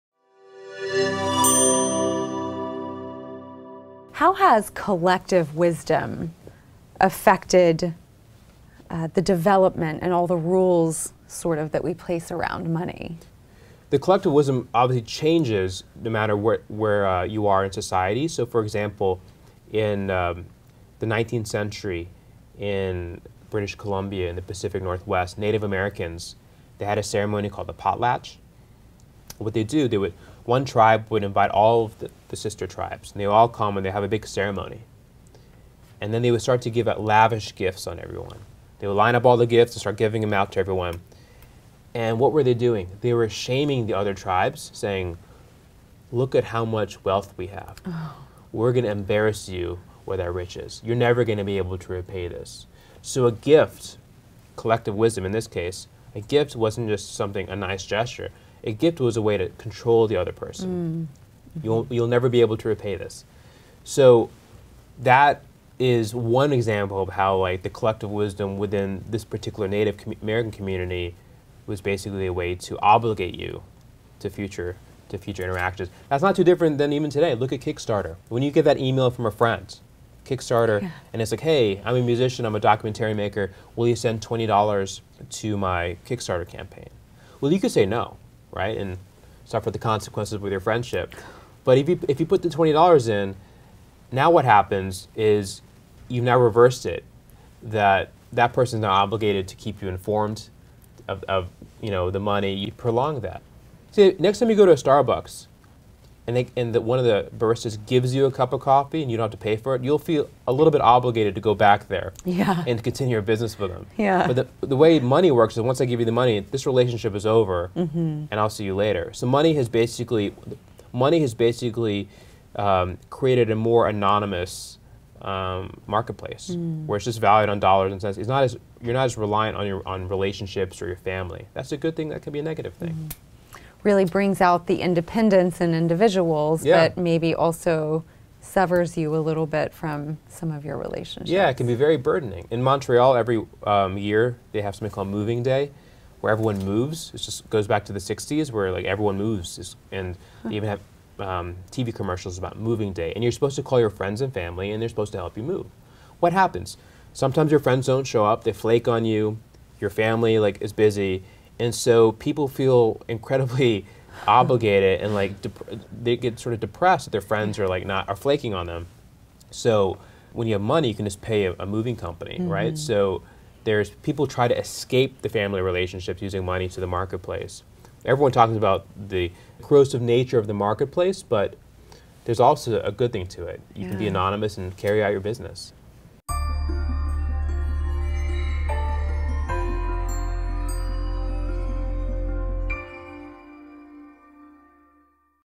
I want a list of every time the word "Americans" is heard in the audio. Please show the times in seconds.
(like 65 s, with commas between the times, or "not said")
25 s, 70 s.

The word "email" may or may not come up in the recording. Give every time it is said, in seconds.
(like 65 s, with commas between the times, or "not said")
78 s.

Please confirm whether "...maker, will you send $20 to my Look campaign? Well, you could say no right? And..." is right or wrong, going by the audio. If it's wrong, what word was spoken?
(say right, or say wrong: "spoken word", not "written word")
wrong: "Kickstarter", not "Look".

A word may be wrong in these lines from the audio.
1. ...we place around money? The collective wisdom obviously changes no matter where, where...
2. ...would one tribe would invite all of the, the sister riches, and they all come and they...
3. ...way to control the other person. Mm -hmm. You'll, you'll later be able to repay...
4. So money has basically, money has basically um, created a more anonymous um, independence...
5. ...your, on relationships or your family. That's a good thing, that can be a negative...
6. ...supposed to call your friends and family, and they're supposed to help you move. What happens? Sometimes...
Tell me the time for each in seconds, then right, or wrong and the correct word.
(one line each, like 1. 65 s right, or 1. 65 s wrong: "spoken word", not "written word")
1. 11 s right
2. 29 s wrong: "tribes", not "riches"
3. 59 s wrong: "never", not "later"
4. 119 s wrong: "marketplace", not "independence"
5. 129 s right
6. 153 s right.